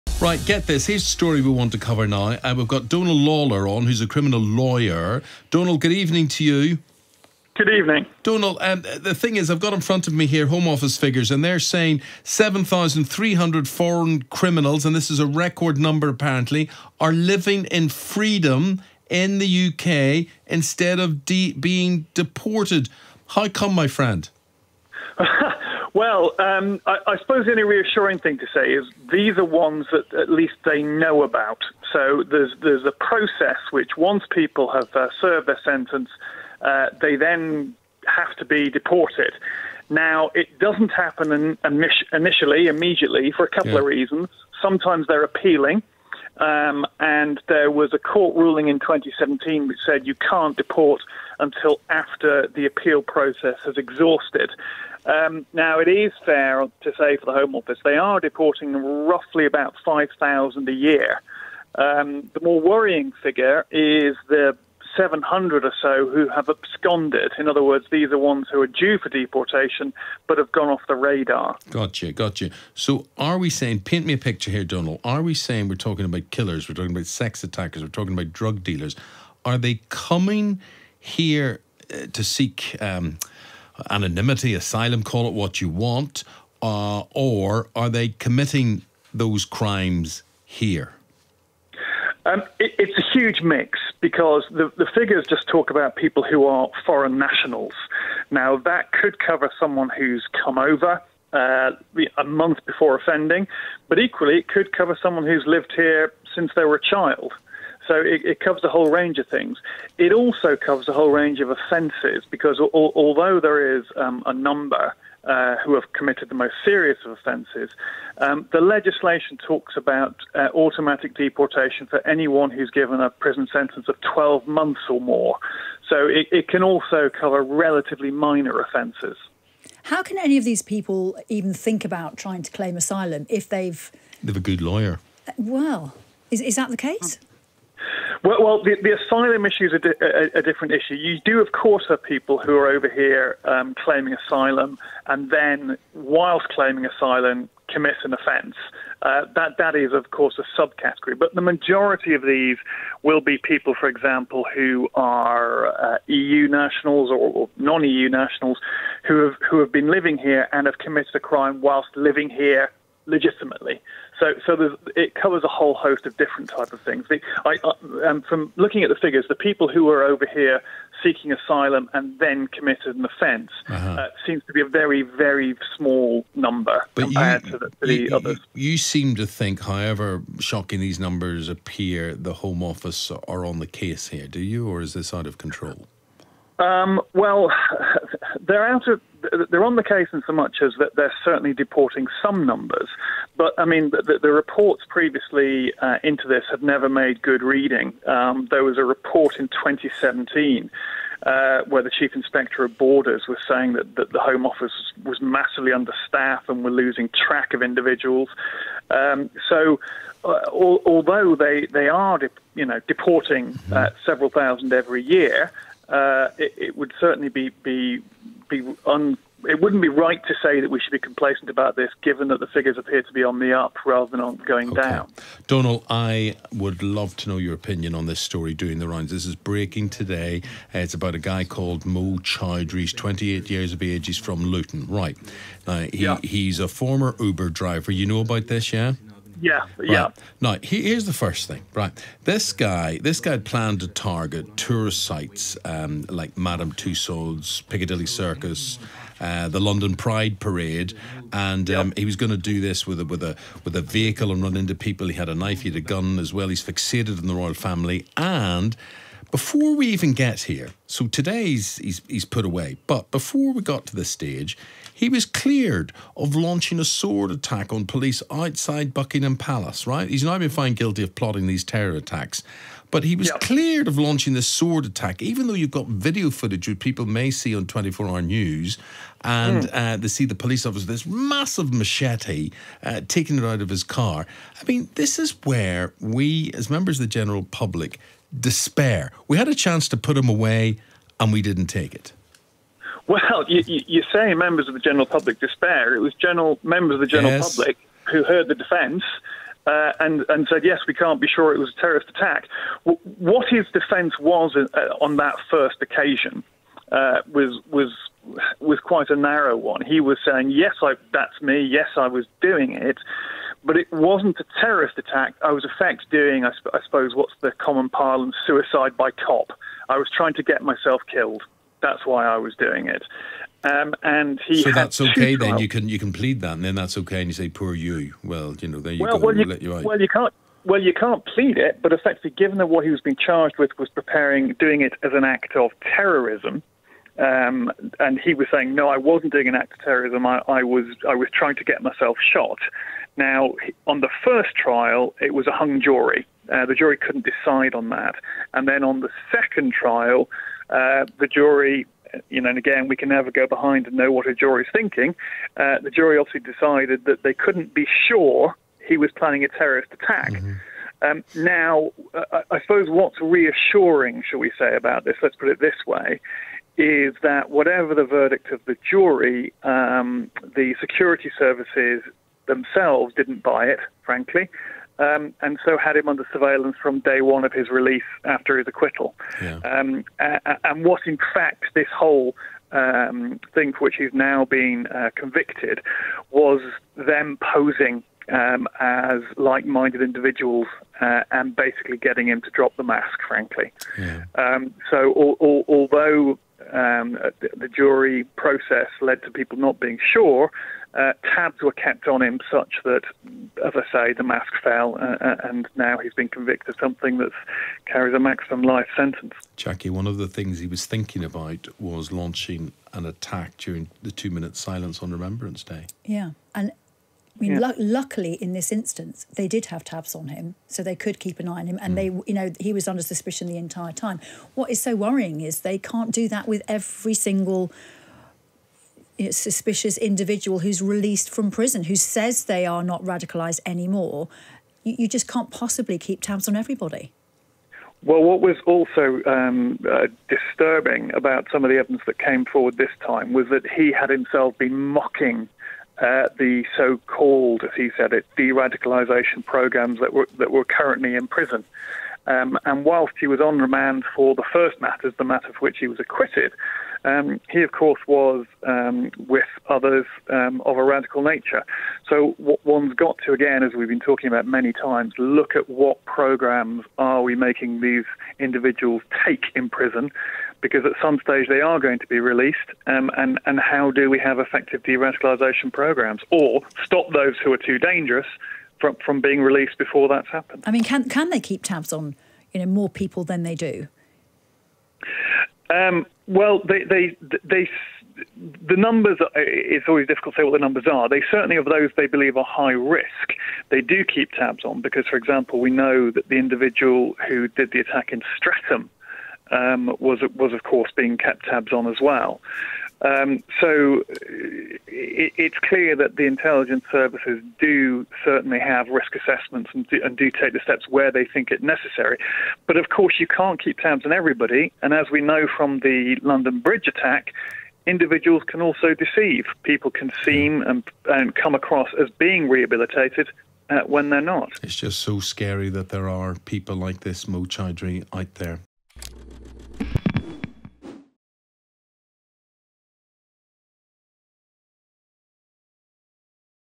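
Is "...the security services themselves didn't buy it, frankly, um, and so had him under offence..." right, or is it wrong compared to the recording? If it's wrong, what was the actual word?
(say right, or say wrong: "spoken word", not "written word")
wrong: "surveillance", not "offence".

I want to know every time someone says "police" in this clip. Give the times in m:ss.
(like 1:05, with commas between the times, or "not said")
4:27, 4:40.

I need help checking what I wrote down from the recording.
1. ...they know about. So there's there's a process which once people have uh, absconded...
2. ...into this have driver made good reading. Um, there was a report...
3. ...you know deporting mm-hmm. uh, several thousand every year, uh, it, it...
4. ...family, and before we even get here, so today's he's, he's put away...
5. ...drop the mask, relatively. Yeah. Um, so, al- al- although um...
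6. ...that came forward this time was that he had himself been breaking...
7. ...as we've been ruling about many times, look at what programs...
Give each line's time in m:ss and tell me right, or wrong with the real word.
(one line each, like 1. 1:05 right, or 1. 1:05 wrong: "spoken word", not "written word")
1. 0:30 wrong: "served", not "absconded"
2. 3:16 wrong: "never", not "driver"
3. 3:32 right
4. 4:17 right
5. 6:32 wrong: "frankly", not "relatively"
6. 7:22 wrong: "mocking", not "breaking"
7. 7:43 wrong: "talking", not "ruling".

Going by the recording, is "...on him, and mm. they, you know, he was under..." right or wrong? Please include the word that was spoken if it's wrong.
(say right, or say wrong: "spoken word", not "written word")
right.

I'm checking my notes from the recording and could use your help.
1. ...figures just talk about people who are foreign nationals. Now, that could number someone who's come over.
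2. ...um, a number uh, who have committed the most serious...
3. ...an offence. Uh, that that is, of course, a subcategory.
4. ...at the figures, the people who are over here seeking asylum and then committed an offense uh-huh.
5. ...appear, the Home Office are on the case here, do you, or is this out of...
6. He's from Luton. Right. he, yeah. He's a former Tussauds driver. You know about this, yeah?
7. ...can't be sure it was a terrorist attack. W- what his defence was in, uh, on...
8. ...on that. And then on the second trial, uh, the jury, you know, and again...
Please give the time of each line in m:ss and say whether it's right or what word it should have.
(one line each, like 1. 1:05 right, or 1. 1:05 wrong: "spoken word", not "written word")
1. 1:34 wrong: "cover", not "number"
2. 1:53 right
3. 2:28 right
4. 2:48 right
5. 3:01 right
6. 3:54 wrong: "Uber", not "Tussauds"
7. 5:00 right
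8. 5:47 right.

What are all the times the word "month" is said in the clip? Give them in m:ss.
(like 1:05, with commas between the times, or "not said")
1:42, 2:04.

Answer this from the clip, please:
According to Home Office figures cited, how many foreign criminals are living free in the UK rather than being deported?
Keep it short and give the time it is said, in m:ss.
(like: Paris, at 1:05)
7,300, at 0:12.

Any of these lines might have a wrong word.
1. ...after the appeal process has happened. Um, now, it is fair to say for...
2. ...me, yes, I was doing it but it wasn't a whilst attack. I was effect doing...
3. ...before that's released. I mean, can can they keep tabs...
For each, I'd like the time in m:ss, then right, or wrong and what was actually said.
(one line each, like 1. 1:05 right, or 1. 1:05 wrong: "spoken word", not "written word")
1. 0:51 wrong: "exhausted", not "happened"
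2. 5:11 wrong: "terrorist", not "whilst"
3. 7:59 wrong: "happened", not "released".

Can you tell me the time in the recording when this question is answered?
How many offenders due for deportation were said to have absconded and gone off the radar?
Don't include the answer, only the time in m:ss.
1:04.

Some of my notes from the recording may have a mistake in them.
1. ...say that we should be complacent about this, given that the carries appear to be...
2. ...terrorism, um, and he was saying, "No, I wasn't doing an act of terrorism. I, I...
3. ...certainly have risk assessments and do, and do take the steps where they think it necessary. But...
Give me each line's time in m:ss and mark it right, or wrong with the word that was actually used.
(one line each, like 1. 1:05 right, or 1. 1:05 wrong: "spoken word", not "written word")
1. 3:40 wrong: "figures", not "carries"
2. 5:35 right
3. 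8:28 right.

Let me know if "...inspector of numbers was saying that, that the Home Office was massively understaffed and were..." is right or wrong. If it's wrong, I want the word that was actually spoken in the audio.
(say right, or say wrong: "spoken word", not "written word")
wrong: "borders", not "numbers".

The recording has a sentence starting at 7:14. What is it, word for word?
You, you just can't possibly keep tabs on everybody.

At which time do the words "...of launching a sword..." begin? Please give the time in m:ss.
4:26.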